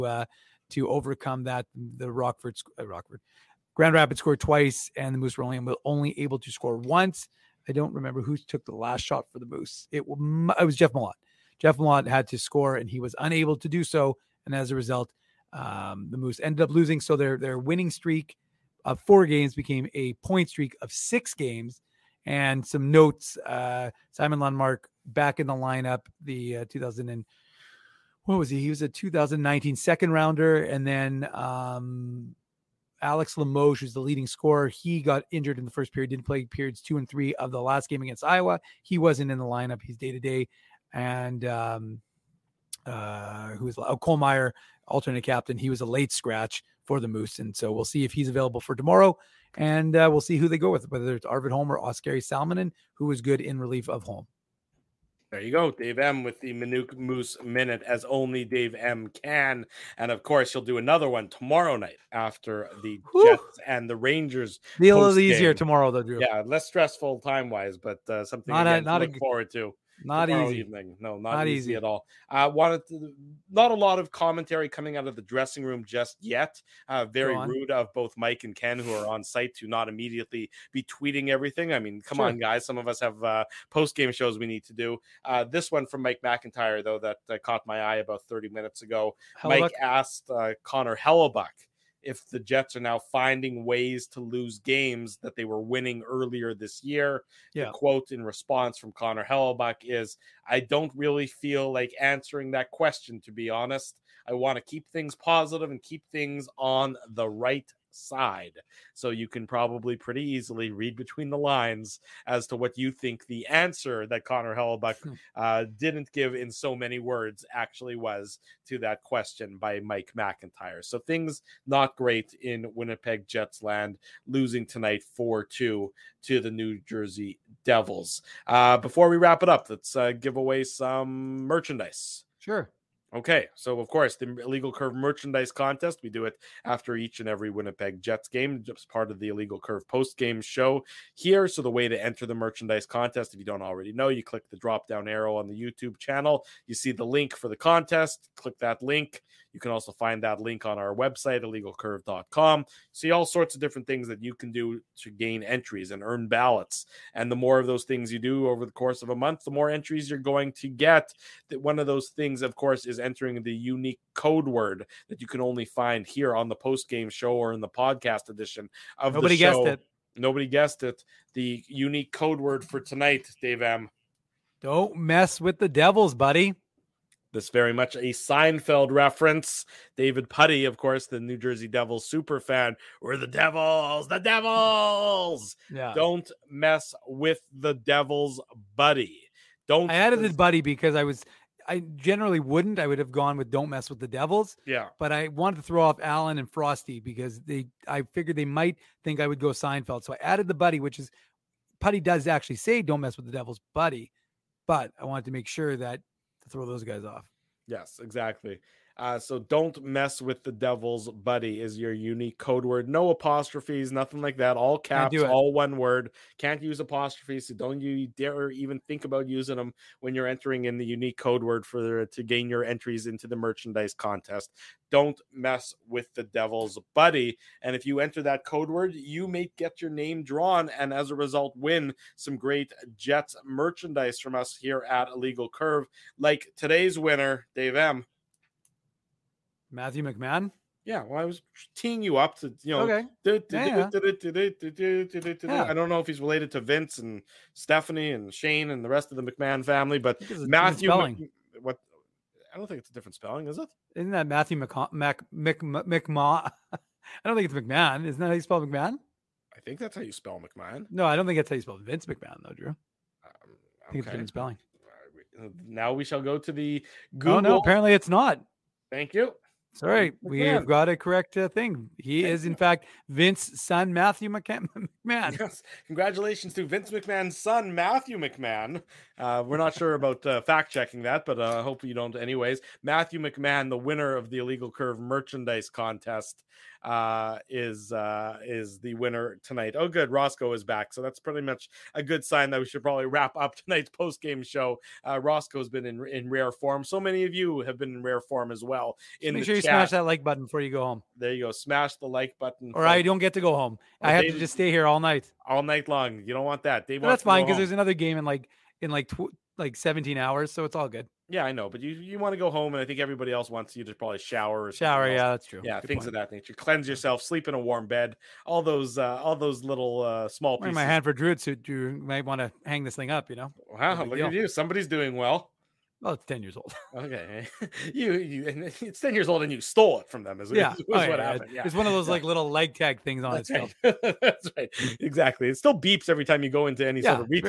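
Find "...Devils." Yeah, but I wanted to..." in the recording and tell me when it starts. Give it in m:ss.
3:14.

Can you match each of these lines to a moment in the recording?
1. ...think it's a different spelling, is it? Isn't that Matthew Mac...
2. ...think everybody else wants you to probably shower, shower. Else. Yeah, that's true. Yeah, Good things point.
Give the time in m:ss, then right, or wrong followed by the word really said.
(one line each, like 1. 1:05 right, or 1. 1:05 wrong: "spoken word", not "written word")
1. 4:12 right
2. 5:12 right.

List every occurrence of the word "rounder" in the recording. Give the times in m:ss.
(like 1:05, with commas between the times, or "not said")
0:30.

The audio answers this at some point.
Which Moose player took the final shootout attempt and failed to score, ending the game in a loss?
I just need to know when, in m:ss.
0:11.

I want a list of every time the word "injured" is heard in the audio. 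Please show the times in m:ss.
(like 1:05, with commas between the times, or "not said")
0:35.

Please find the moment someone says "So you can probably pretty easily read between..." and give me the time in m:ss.
1:48.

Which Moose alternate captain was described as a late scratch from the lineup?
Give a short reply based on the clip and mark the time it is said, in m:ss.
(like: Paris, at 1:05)
Cole Meyer, at 0:43.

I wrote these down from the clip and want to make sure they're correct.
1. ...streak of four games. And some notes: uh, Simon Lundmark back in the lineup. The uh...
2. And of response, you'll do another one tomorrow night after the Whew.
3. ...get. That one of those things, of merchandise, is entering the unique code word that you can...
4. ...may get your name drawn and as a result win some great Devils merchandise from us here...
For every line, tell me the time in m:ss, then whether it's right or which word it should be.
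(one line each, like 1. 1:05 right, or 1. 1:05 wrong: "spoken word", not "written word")
1. 0:20 wrong: "six", not "four"
2. 0:59 wrong: "course", not "response"
3. 2:40 wrong: "course", not "merchandise"
4. 3:49 wrong: "Jets", not "Devils".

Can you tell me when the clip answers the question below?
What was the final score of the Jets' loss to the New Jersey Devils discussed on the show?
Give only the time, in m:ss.
2:05.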